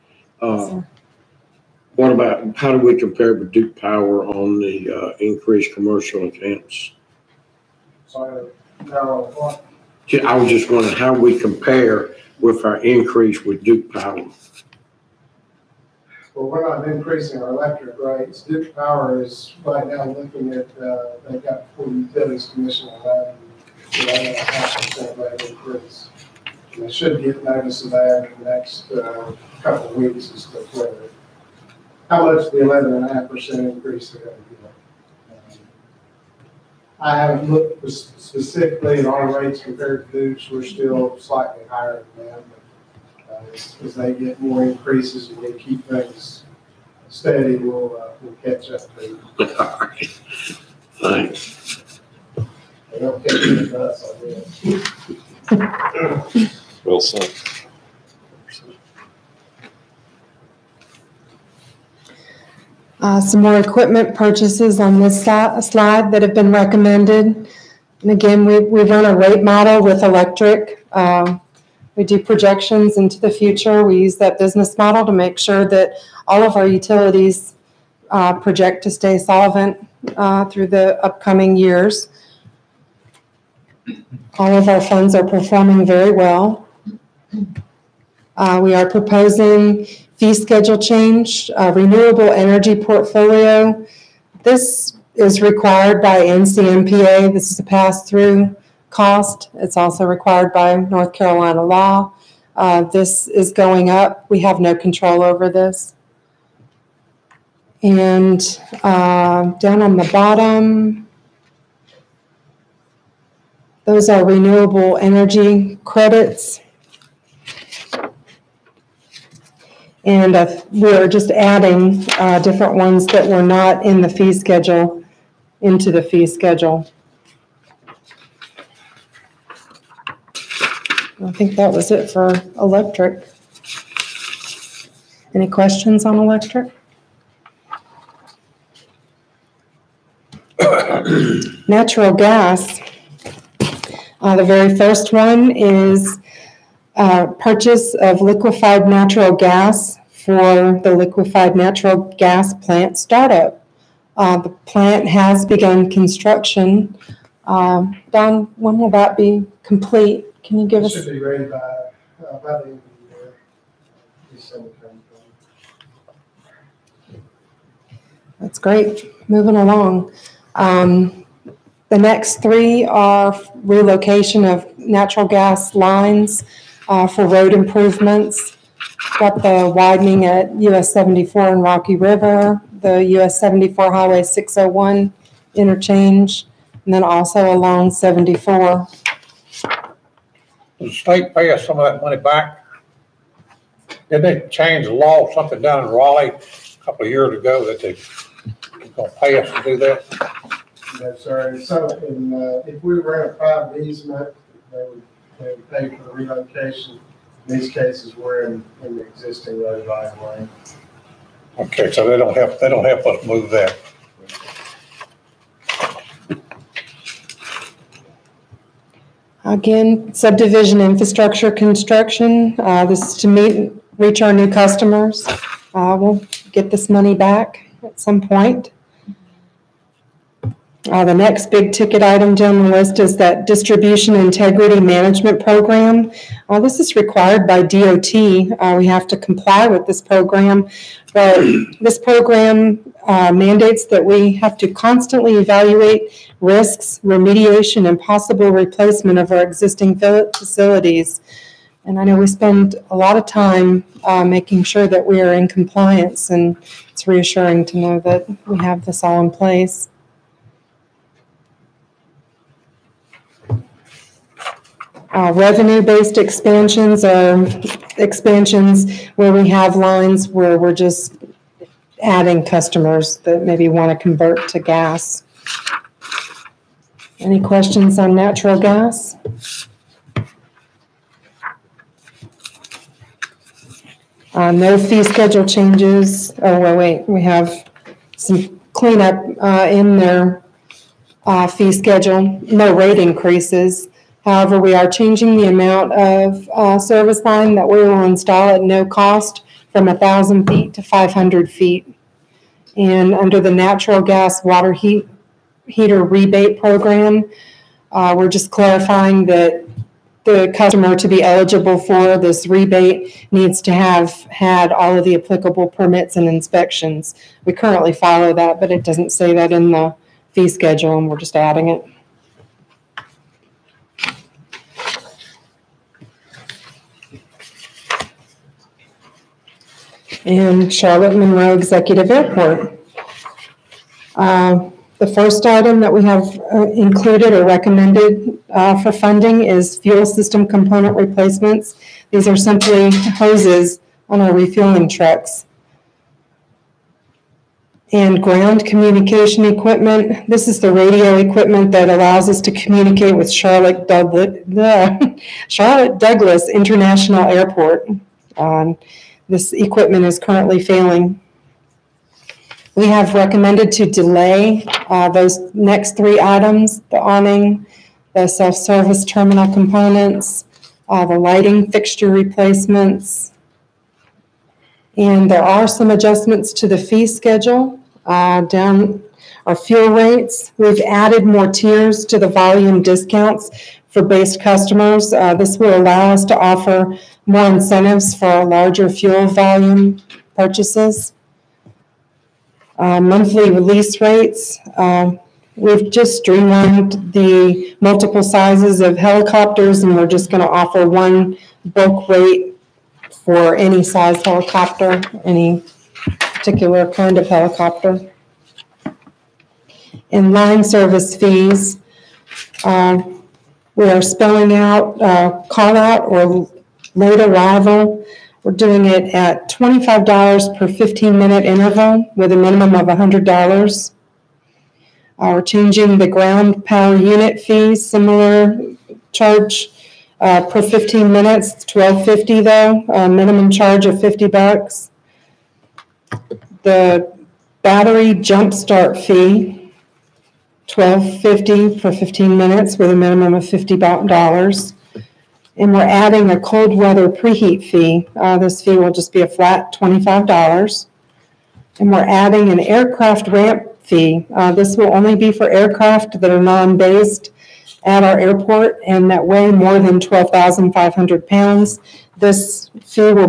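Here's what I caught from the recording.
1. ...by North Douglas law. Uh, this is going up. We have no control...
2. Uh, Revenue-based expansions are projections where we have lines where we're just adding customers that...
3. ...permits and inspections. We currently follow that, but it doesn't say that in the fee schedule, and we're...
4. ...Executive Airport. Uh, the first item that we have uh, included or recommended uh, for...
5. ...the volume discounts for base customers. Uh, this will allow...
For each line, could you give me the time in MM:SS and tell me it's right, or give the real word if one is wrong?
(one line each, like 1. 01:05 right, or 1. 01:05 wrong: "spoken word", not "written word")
1. 01:40 wrong: "Carolina", not "Douglas"
2. 04:25 wrong: "expansions", not "projections"
3. 05:15 right
4. 05:31 right
5. 06:22 right.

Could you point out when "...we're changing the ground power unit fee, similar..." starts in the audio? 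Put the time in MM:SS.
07:05.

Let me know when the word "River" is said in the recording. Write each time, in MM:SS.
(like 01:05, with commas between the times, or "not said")
03:01.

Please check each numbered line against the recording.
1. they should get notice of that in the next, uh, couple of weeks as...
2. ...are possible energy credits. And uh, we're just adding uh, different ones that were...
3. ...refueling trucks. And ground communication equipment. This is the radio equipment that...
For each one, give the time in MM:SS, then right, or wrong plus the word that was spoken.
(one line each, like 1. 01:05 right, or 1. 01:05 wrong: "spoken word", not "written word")
1. 00:26 right
2. 01:54 wrong: "renewable", not "possible"
3. 05:44 right.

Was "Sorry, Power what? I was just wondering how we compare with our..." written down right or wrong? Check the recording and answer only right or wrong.
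right.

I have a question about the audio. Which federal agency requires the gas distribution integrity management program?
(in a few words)
DOT.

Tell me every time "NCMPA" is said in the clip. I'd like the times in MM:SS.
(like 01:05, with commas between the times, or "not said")
01:36.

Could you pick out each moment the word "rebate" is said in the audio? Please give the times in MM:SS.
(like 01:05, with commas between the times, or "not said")
05:06, 05:12.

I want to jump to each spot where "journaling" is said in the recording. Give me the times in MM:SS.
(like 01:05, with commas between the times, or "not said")
not said.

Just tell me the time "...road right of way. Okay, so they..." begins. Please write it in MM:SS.
03:29.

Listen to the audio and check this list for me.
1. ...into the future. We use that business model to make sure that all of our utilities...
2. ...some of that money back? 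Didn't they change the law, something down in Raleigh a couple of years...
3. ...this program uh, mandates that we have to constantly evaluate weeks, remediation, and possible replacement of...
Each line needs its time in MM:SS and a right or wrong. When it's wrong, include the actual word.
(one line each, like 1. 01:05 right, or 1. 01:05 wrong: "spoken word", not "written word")
1. 01:12 right
2. 03:11 right
3. 04:01 wrong: "risks", not "weeks".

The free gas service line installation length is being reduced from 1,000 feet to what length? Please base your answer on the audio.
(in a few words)
500 feet.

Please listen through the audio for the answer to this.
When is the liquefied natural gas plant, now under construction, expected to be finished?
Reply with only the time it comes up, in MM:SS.
02:42.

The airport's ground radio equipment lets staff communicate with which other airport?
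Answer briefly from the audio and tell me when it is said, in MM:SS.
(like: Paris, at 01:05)
Charlotte Douglas International Airport, at 05:55.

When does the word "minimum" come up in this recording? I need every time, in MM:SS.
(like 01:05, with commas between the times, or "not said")
07:02, 07:13, 07:22.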